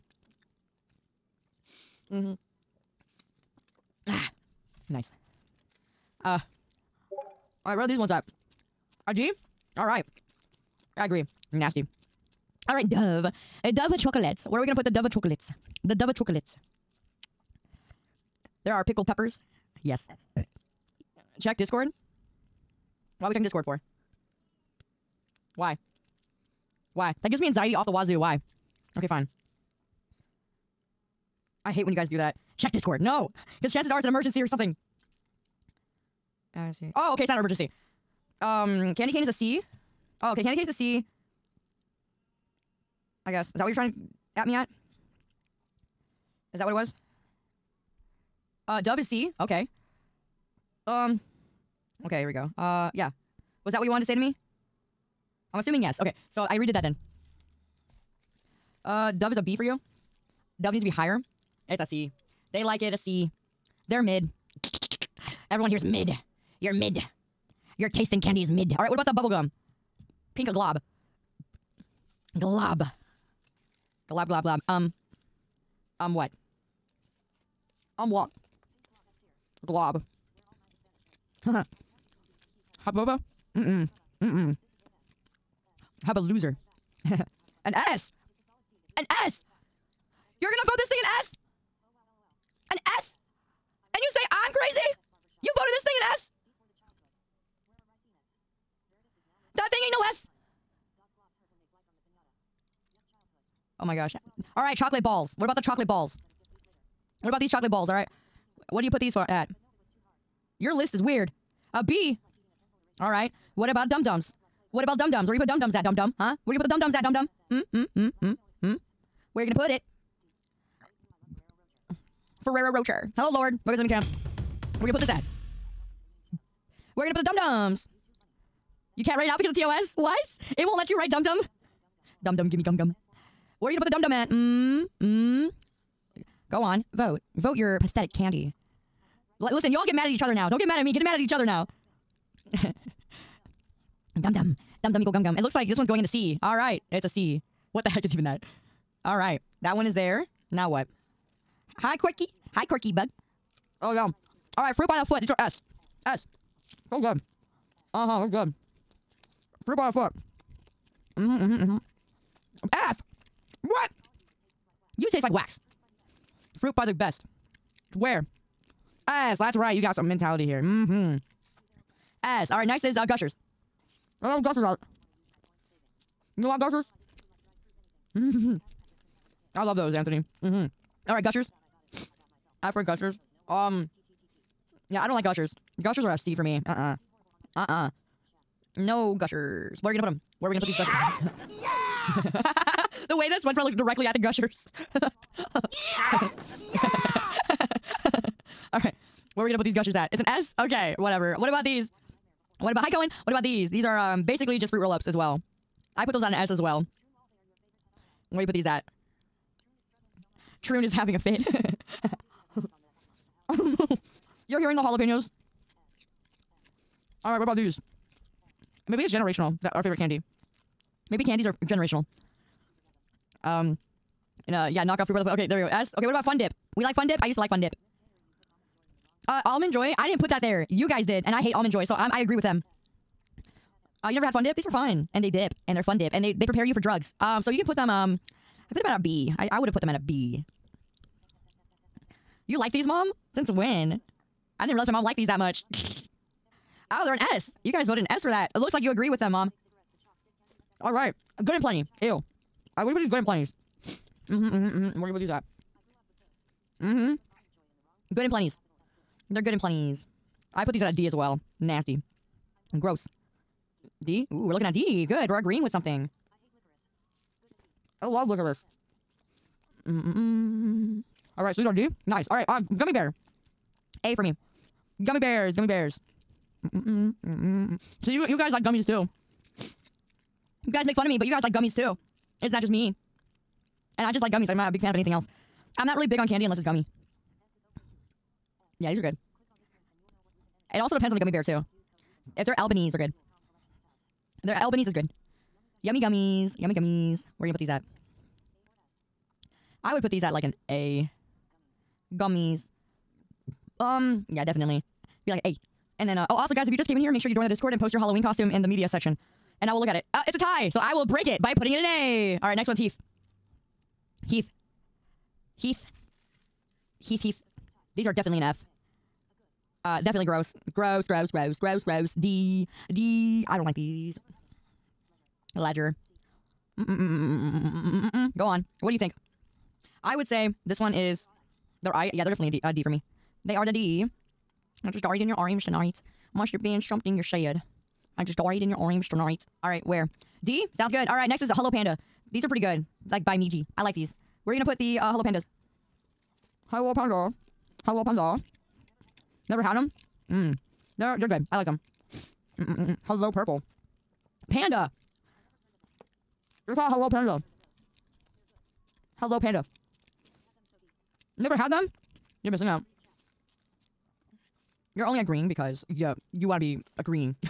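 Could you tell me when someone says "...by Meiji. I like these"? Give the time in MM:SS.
05:43.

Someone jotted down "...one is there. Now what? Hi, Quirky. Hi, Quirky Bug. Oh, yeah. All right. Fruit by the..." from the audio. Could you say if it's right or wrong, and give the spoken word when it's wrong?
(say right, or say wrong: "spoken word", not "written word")
right.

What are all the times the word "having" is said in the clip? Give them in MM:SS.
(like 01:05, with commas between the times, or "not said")
03:30.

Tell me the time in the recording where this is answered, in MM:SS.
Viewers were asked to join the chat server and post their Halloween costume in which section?
05:08.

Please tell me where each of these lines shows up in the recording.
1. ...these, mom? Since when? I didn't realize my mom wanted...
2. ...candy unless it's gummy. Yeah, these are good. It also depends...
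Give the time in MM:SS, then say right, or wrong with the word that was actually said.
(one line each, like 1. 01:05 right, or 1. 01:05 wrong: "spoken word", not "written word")
1. 04:02 wrong: "liked", not "wanted"
2. 04:46 right.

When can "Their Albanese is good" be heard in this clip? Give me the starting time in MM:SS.
04:54.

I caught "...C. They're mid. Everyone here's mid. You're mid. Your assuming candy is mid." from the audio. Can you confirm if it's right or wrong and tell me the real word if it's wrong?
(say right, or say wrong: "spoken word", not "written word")
wrong: "tasting", not "assuming".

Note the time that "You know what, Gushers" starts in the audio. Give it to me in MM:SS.
02:56.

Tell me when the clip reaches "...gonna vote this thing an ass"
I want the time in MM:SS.
01:30.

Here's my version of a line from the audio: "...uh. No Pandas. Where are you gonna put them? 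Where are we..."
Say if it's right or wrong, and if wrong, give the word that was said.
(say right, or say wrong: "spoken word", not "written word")
wrong: "Gushers", not "Pandas".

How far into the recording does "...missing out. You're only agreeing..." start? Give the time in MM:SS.
06:02.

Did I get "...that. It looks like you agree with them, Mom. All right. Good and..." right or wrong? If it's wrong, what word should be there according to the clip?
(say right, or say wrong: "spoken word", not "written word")
right.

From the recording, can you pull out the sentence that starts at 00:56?
Okay, so I redid that then.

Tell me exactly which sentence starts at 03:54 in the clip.
These were fun, and they dip, and they're Fun Dip, and they they prepare you for drugs.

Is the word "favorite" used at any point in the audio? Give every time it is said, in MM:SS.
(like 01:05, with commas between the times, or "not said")
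03:39.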